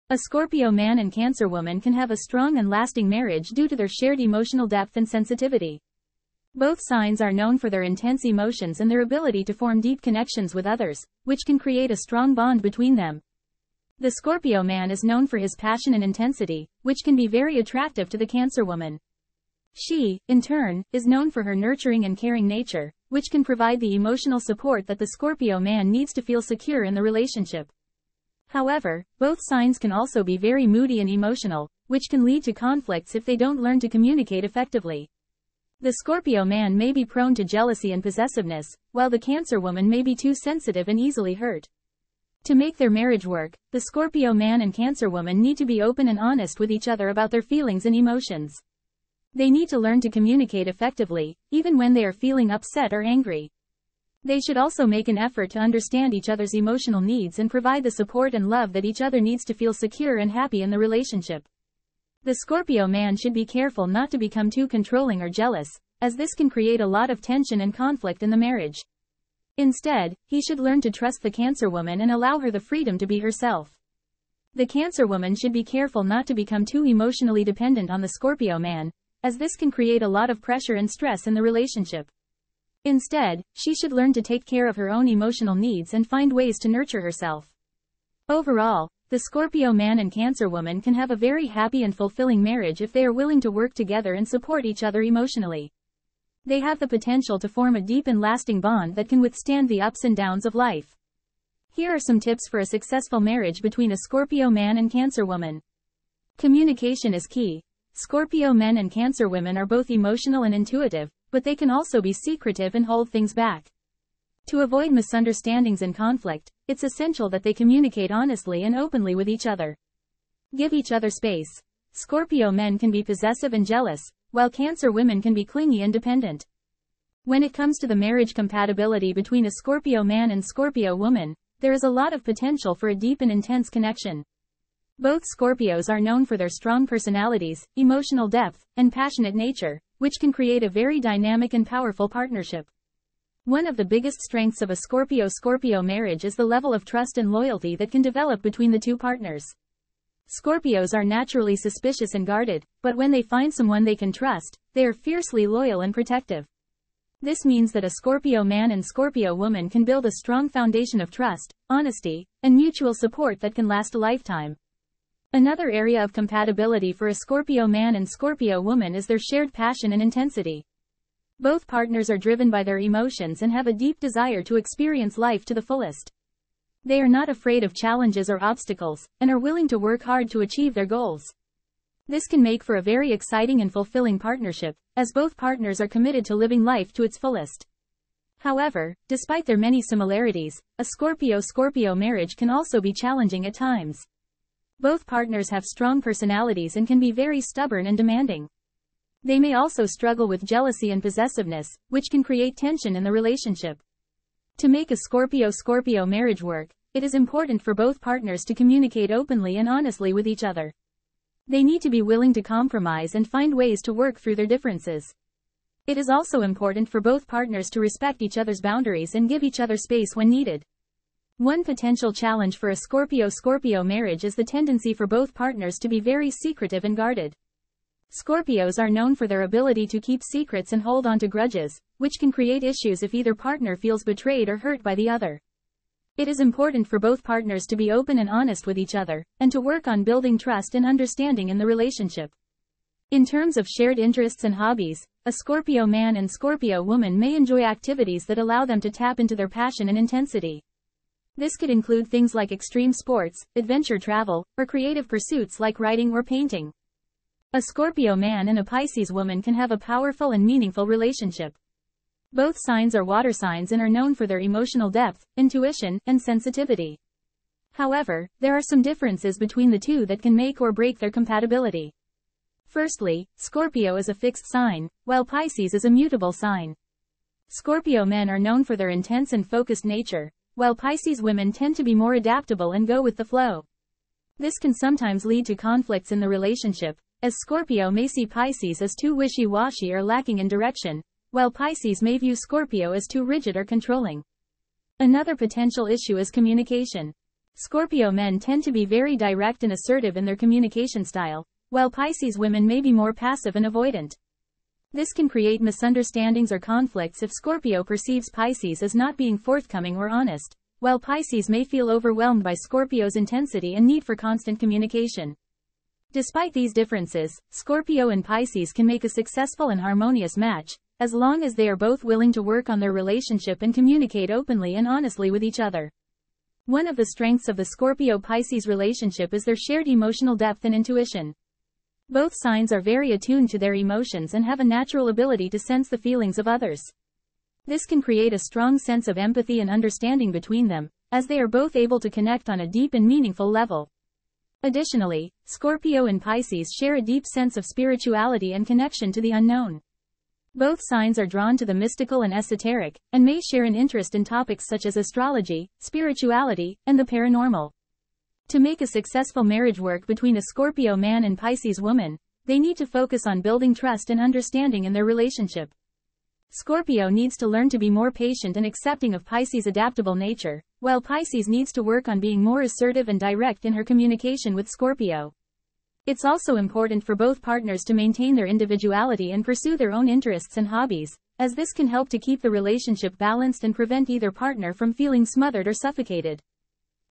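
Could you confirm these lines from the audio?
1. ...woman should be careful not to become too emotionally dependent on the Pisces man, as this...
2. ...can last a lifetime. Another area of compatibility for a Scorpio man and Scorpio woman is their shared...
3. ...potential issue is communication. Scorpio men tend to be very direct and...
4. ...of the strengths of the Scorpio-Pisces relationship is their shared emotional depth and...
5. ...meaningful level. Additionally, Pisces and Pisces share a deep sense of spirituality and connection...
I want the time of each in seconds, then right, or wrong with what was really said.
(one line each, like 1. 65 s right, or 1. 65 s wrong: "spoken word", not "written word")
1. 75 s wrong: "Scorpio", not "Pisces"
2. 163 s right
3. 295 s right
4. 326 s right
5. 343 s wrong: "Scorpio", not "Pisces".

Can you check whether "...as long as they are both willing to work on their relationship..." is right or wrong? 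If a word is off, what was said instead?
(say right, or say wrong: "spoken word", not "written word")
right.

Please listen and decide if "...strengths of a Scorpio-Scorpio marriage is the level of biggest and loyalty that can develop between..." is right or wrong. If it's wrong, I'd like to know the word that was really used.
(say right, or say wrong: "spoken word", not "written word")
wrong: "trust", not "biggest".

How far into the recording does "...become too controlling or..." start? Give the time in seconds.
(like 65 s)
64 s.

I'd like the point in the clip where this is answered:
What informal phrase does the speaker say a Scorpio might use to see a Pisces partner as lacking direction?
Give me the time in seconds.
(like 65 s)
289 s.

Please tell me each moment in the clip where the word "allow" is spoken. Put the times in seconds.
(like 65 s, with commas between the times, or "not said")
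72 s, 248 s.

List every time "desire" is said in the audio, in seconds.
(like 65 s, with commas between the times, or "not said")
174 s.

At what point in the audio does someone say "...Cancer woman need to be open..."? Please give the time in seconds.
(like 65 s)
44 s.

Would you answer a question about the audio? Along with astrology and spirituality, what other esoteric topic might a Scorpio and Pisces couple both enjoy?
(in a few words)
the paranormal.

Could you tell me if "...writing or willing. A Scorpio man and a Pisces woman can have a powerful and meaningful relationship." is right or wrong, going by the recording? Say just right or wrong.
wrong.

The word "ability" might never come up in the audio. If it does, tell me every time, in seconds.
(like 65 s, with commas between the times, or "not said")
9 s, 229 s, 335 s.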